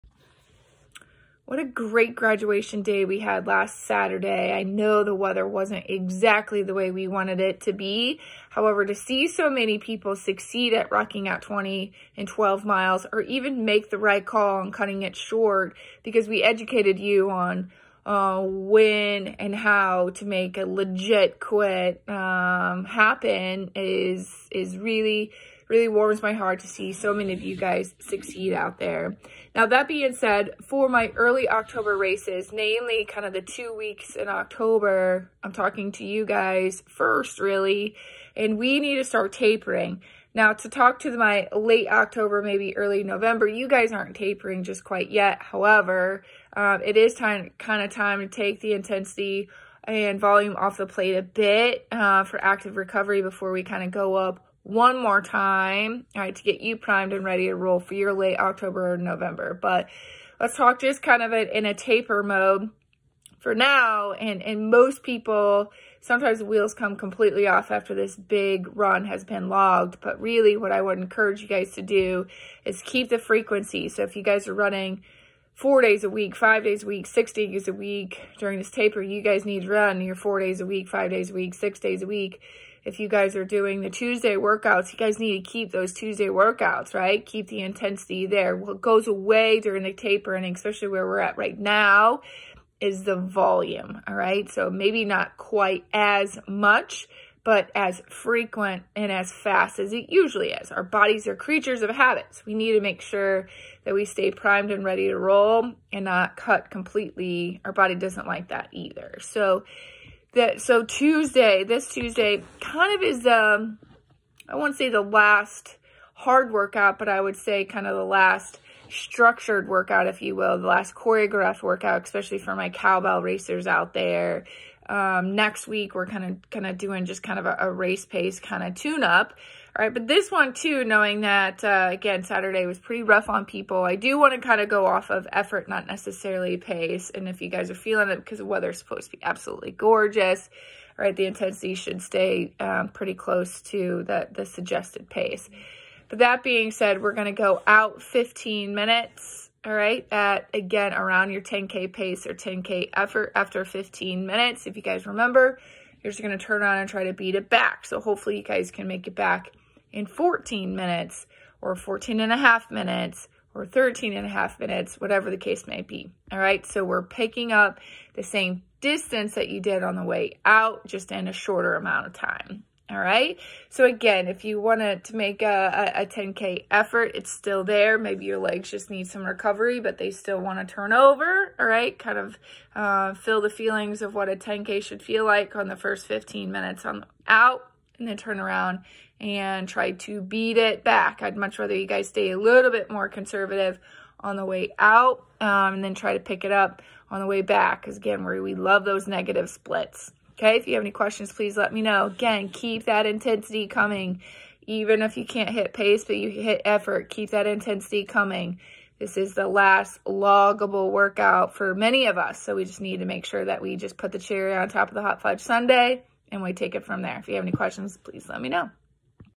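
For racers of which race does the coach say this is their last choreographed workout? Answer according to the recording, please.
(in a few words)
Cowbell.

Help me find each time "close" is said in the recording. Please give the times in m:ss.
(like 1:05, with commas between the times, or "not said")
2:23.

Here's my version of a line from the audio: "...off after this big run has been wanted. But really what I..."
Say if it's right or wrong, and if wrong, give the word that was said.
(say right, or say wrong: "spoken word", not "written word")
wrong: "logged", not "wanted".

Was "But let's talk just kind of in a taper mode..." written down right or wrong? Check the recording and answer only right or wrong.
right.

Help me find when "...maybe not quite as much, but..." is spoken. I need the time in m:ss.
1:34.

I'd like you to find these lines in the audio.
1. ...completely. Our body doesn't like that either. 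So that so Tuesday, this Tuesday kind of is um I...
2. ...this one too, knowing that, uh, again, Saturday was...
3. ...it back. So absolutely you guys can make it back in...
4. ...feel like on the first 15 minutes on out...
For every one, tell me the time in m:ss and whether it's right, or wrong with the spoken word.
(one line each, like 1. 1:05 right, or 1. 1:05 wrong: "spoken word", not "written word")
1. 1:46 right
2. 2:10 right
3. 2:37 wrong: "hopefully", not "absolutely"
4. 3:05 right.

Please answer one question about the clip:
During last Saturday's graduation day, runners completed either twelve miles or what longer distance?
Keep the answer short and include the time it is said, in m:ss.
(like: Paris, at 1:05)
20 miles, at 0:11.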